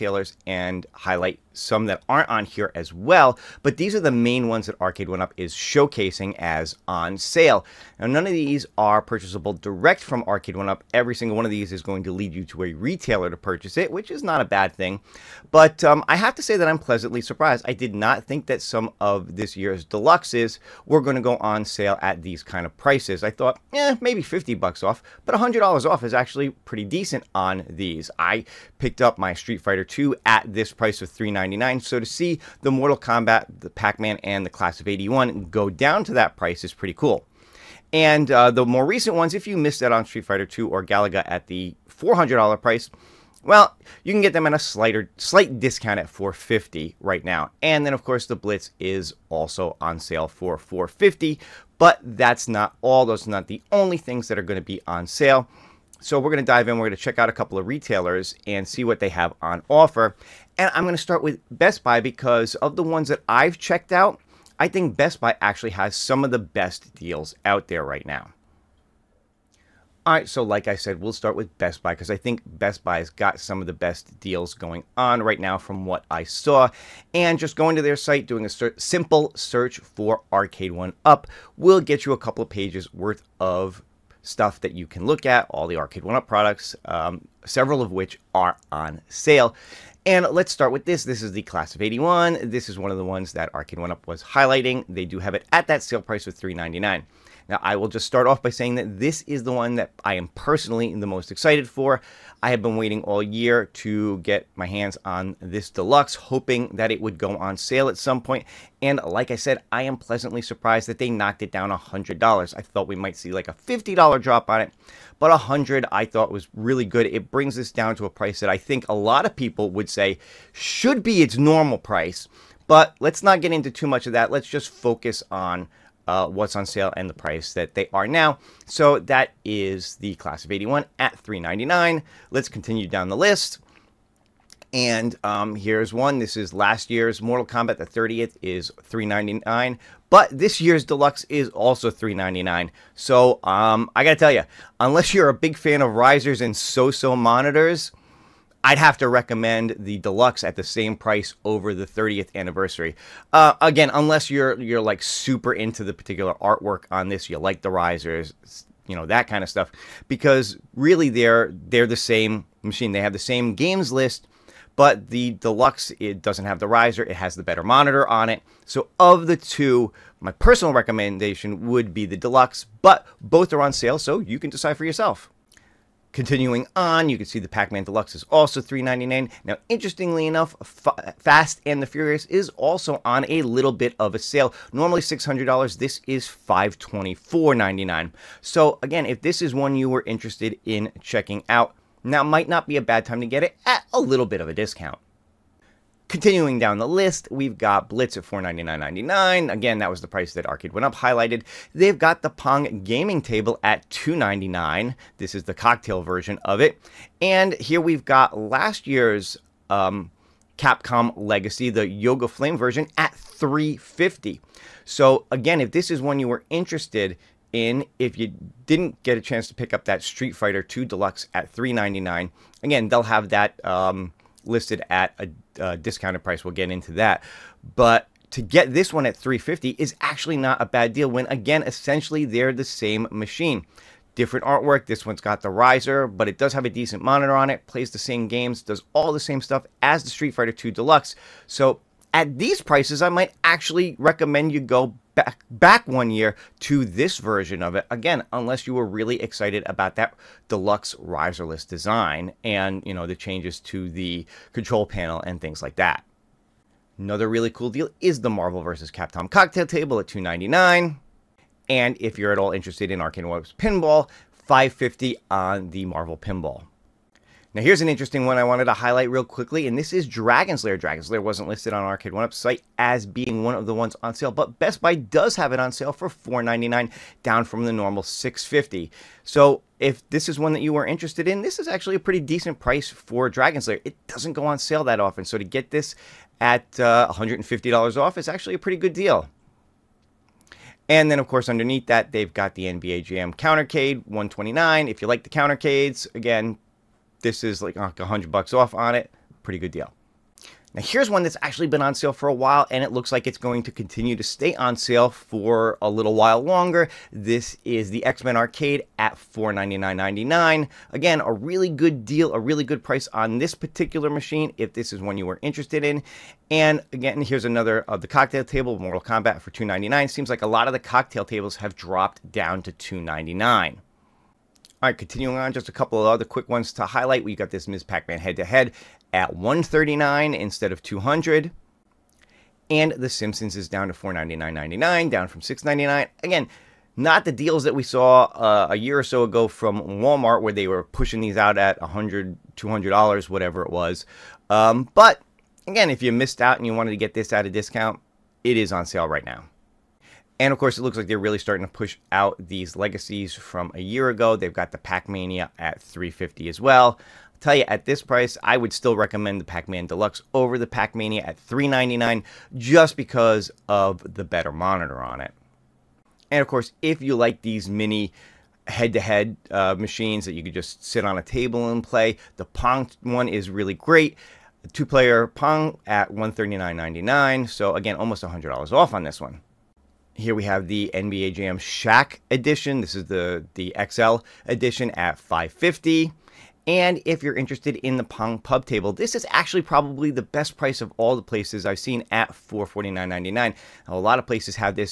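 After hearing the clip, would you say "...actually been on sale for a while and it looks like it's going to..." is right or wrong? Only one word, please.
right.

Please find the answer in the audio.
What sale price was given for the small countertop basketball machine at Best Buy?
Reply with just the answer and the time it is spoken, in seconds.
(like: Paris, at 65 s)
129, at 294 s.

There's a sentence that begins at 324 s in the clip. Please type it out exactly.
All right, continuing on, just a couple of other quick ones to highlight.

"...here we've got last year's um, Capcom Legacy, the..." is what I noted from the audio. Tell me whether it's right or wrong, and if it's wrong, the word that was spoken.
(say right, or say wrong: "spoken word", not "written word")
right.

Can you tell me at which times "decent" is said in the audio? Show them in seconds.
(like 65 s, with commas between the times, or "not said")
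26 s, 236 s, 282 s.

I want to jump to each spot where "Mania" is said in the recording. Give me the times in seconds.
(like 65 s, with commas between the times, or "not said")
355 s, 360 s.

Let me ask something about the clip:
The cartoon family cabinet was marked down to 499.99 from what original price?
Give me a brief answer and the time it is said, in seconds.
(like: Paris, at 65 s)
699, at 335 s.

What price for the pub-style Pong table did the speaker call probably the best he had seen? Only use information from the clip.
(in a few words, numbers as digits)
$449.99.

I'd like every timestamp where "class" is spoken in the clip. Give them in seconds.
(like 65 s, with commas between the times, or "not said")
34 s, 91 s, 130 s.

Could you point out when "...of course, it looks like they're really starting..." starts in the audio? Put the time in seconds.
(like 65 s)
350 s.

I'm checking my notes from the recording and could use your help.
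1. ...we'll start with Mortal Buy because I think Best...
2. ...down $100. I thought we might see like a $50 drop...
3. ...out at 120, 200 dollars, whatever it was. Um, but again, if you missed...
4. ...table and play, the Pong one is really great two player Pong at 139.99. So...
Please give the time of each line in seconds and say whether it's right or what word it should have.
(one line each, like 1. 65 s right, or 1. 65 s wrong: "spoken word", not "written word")
1. 70 s wrong: "Best", not "Mortal"
2. 111 s right
3. 341 s wrong: "100", not "120"
4. 371 s right.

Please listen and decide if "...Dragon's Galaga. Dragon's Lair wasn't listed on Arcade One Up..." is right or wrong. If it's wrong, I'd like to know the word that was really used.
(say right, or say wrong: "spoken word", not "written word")
wrong: "Lair", not "Galaga".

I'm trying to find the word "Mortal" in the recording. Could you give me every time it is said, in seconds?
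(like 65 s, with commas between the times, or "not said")
32 s, 137 s, 318 s.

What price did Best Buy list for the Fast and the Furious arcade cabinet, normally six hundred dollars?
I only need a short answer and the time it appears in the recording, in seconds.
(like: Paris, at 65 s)
$524.99, at 186 s.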